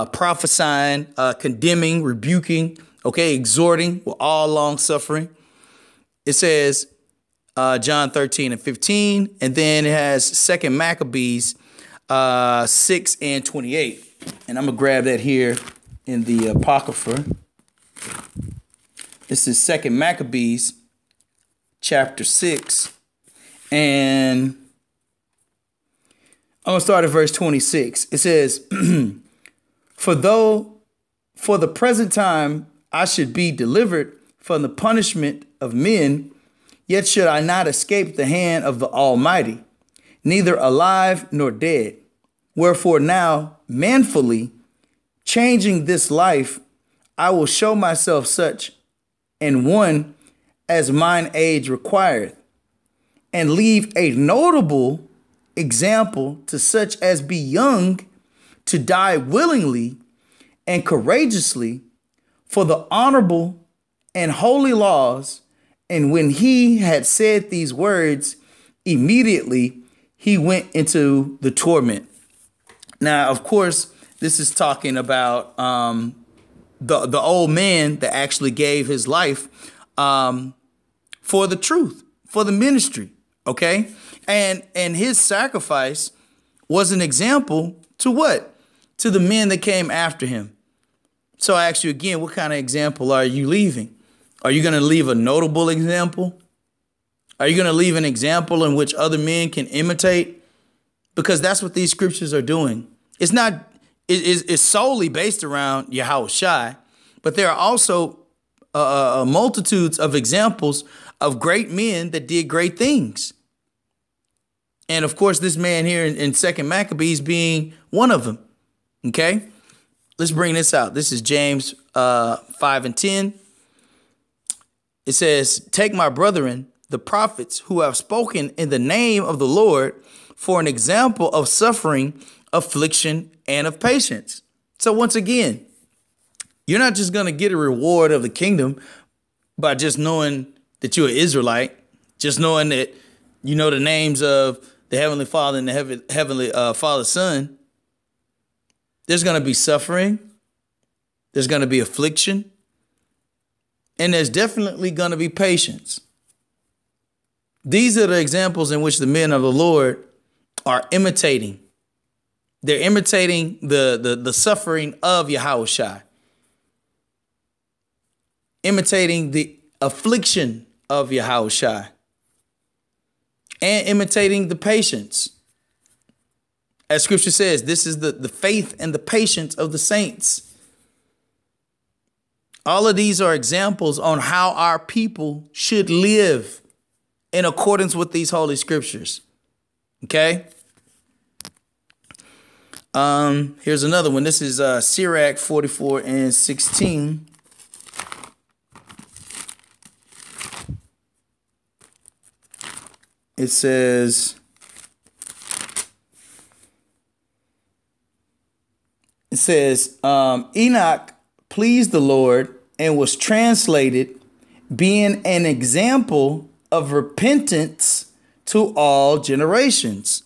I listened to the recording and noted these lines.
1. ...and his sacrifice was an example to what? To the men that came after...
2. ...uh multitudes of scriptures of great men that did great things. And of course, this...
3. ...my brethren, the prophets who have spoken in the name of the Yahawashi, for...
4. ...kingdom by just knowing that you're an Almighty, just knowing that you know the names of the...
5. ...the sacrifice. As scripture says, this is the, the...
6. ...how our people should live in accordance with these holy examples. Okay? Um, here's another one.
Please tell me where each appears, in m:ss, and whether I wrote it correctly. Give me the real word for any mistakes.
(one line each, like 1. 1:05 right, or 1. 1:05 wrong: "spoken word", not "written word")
1. 1:24 right
2. 1:49 wrong: "examples", not "scriptures"
3. 2:05 wrong: "Lord", not "Yahawashi"
4. 2:18 wrong: "Israelite", not "Almighty"
5. 2:54 wrong: "patience", not "sacrifice"
6. 3:04 wrong: "scriptures", not "examples".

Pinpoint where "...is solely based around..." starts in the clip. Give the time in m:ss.
1:44.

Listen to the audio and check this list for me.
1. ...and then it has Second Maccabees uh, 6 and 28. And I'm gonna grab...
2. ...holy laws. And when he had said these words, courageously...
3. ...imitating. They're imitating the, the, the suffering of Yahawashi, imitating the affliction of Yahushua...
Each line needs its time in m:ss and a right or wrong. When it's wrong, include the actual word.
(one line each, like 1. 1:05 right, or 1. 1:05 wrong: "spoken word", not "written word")
1. 0:09 right
2. 1:04 wrong: "immediately", not "courageously"
3. 2:40 right.